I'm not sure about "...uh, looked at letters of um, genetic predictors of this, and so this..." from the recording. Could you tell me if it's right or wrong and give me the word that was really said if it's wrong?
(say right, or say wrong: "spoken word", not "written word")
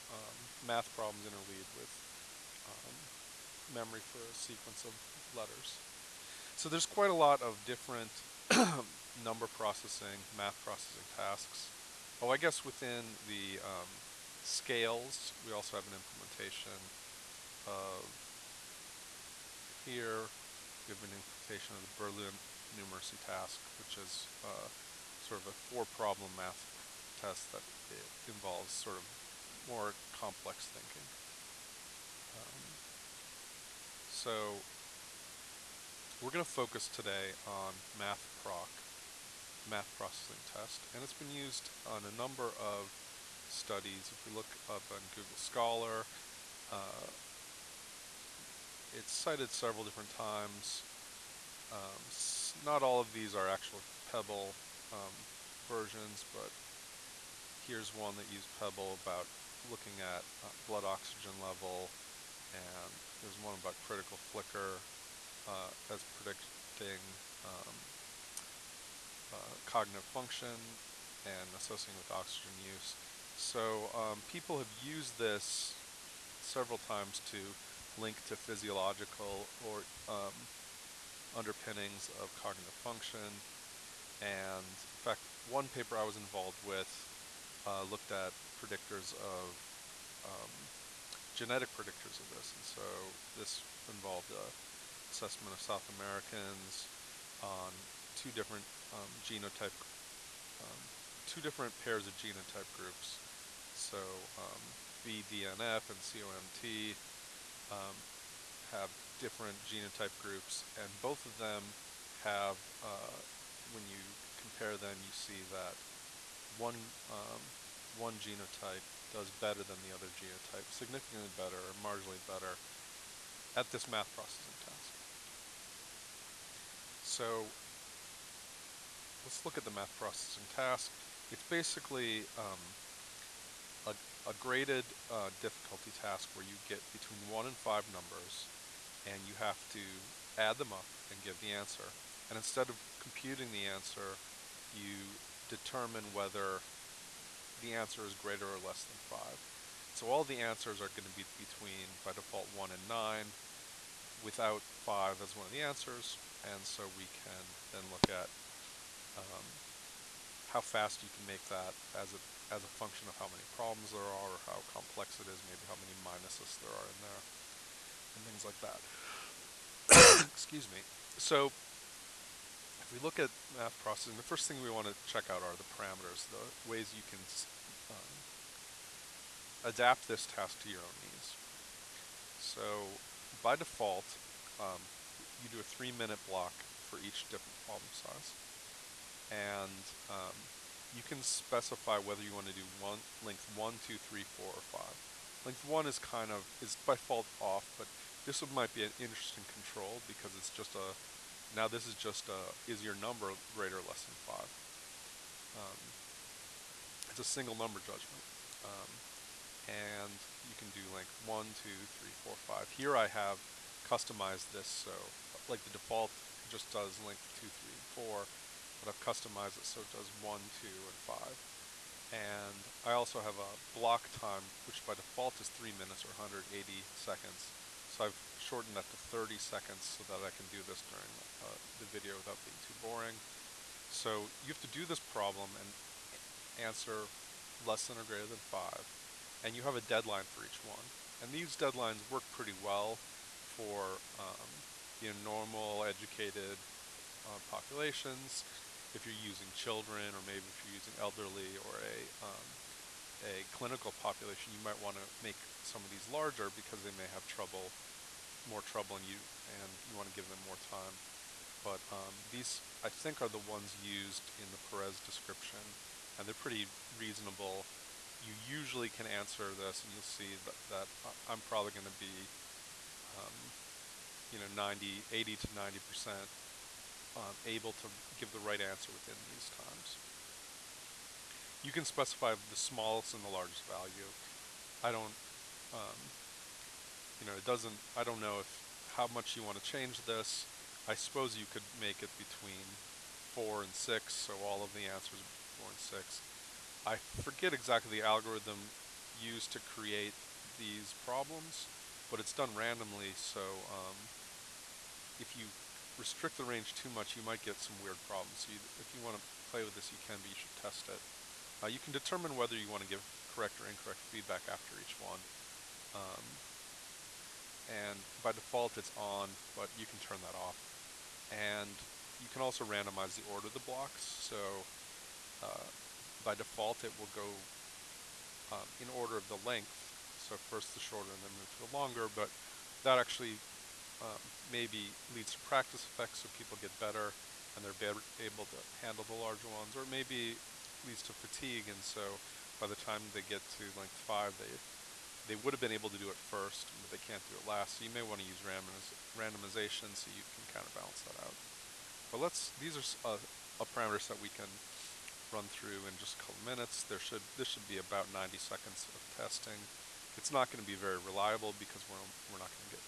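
wrong: "predictors", not "letters".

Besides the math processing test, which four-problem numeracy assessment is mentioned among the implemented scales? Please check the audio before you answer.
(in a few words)
Berlin numeracy task.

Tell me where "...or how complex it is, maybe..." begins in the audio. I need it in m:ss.
2:44.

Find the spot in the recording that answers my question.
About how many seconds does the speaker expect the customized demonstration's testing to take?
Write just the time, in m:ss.
5:58.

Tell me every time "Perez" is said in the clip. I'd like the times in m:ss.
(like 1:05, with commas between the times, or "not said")
4:24.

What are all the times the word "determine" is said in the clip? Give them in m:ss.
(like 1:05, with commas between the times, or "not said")
2:25, 5:11.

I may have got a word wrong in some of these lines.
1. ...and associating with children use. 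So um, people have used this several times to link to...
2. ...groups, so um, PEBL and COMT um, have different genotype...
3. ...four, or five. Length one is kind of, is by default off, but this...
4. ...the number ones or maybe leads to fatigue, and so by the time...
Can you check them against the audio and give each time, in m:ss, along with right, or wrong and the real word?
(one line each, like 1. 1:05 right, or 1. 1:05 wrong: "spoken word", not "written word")
1. 1:11 wrong: "oxygen", not "children"
2. 1:42 wrong: "BDNF", not "PEBL"
3. 3:14 right
4. 5:39 wrong: "larger", not "number".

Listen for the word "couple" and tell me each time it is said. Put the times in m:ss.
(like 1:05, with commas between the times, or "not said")
5:56.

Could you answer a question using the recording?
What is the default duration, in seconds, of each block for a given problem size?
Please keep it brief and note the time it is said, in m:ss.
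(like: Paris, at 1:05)
180, at 3:46.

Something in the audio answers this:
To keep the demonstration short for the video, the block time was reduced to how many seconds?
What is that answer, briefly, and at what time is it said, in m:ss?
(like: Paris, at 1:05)
30, at 3:48.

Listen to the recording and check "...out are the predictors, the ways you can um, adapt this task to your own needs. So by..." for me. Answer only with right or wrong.
wrong.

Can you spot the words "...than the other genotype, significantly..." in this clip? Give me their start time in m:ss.
1:59.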